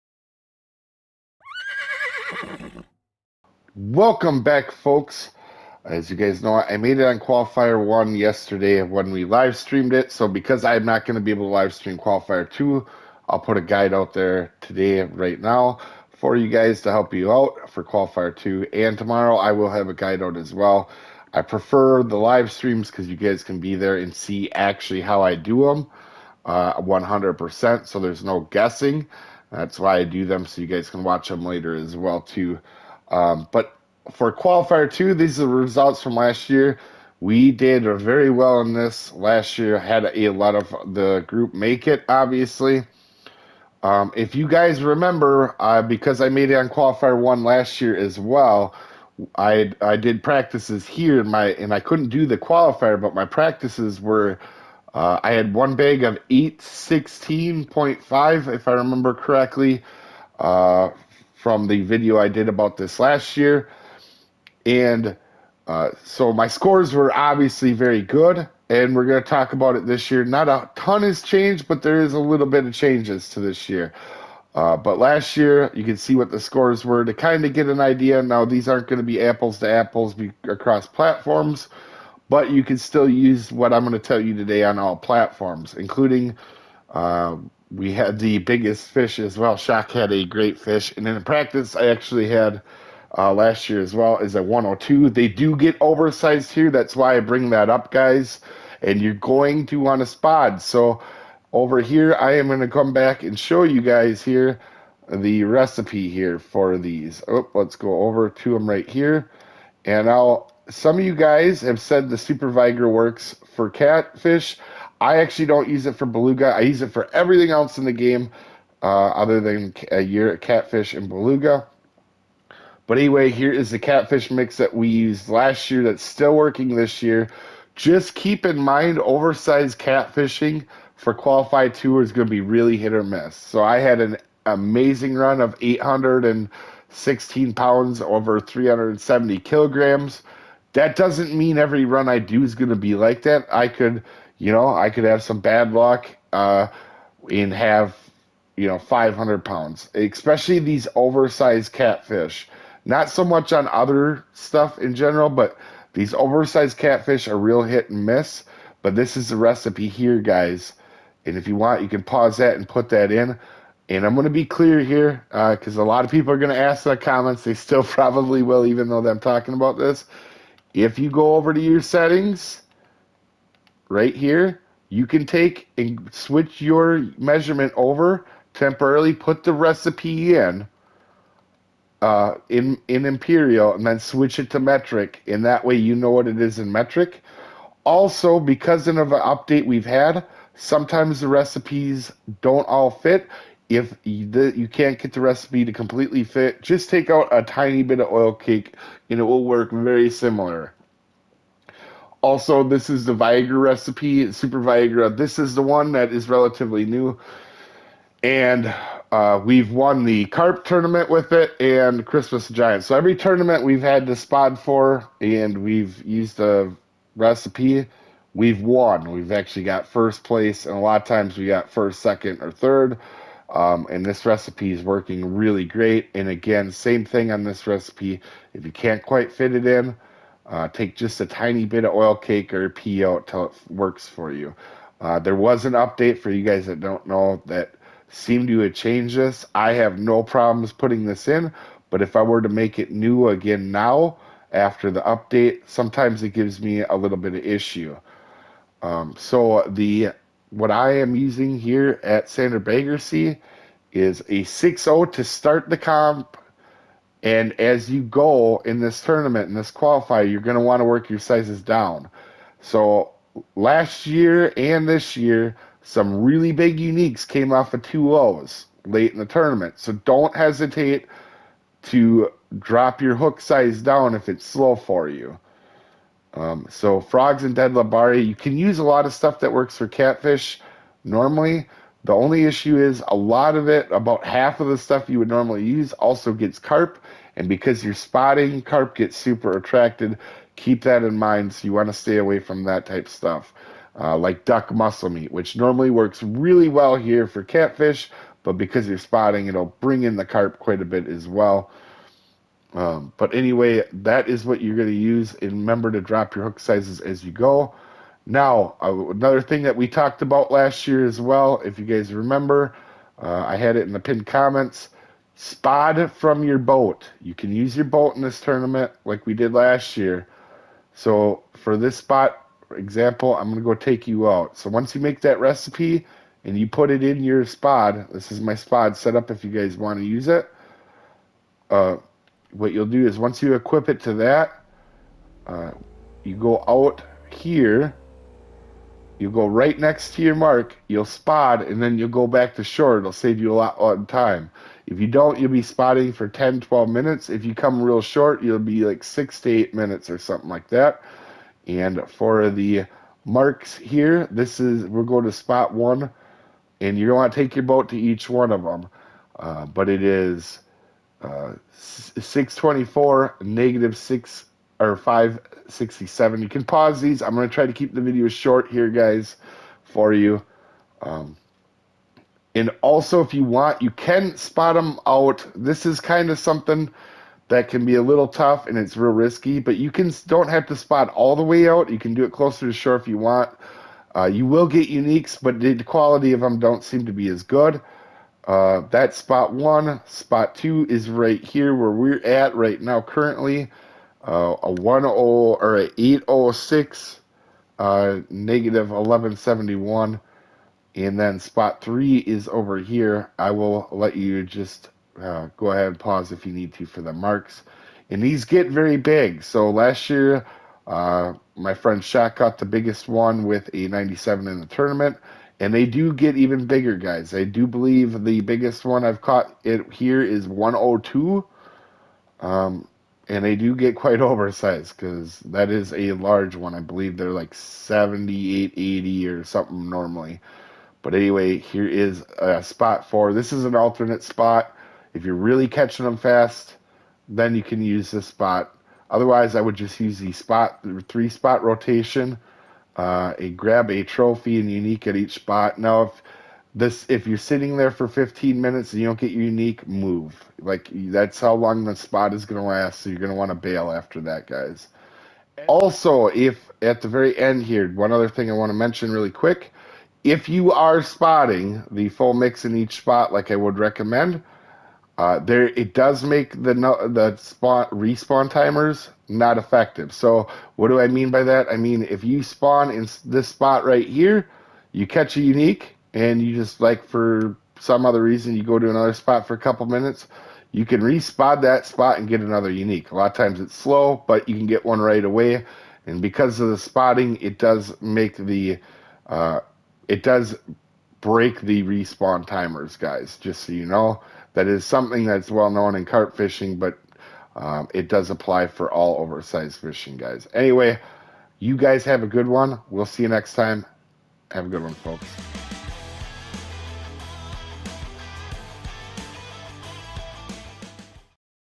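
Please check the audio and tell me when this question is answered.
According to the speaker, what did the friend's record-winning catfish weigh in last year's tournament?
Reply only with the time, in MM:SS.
06:53.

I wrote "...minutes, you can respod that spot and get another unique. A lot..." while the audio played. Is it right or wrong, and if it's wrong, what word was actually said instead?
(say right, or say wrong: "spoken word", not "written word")
right.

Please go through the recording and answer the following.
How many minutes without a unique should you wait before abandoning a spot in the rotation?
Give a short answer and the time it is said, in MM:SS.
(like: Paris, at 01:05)
15 minutes, at 07:28.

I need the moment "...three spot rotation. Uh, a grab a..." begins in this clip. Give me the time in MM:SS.
07:21.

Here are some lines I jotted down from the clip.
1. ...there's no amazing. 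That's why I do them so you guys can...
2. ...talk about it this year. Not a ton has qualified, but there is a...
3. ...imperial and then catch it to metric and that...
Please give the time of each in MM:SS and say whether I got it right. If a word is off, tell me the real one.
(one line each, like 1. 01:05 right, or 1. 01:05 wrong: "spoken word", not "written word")
1. 00:28 wrong: "guessing", not "amazing"
2. 01:09 wrong: "changed", not "qualified"
3. 03:03 wrong: "switch", not "catch".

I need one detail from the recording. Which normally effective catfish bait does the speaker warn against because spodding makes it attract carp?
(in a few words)
duck muscle meat.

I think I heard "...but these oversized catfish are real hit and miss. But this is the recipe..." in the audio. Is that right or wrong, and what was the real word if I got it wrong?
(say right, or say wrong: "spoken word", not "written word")
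right.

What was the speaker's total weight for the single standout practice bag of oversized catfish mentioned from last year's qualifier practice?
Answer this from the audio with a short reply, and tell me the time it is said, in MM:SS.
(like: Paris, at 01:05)
816 pounds, at 02:15.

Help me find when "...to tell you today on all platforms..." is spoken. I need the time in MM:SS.
01:23.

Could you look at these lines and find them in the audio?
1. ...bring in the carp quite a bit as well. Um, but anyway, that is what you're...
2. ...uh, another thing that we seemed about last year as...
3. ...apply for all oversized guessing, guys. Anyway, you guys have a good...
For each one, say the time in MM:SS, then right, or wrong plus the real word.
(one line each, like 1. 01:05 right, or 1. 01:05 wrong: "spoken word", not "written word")
1. 04:59 right
2. 05:08 wrong: "talked", not "seemed"
3. 08:18 wrong: "fishing", not "guessing".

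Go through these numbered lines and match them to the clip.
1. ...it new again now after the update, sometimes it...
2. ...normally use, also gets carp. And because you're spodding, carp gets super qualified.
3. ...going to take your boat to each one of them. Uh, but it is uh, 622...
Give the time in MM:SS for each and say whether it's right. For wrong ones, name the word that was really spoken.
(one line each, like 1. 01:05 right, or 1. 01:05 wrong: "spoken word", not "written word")
1. 04:02 right
2. 04:45 wrong: "attracted", not "qualified"
3. 05:57 wrong: "624", not "622".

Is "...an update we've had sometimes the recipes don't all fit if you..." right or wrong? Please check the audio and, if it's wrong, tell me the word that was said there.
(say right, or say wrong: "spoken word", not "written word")
right.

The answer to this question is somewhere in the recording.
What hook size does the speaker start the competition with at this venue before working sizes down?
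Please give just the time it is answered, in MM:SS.
04:14.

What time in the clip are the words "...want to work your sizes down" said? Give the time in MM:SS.
04:20.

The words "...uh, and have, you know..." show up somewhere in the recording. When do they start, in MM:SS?
02:26.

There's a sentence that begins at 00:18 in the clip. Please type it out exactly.
And tomorrow, I will have a guide out as well.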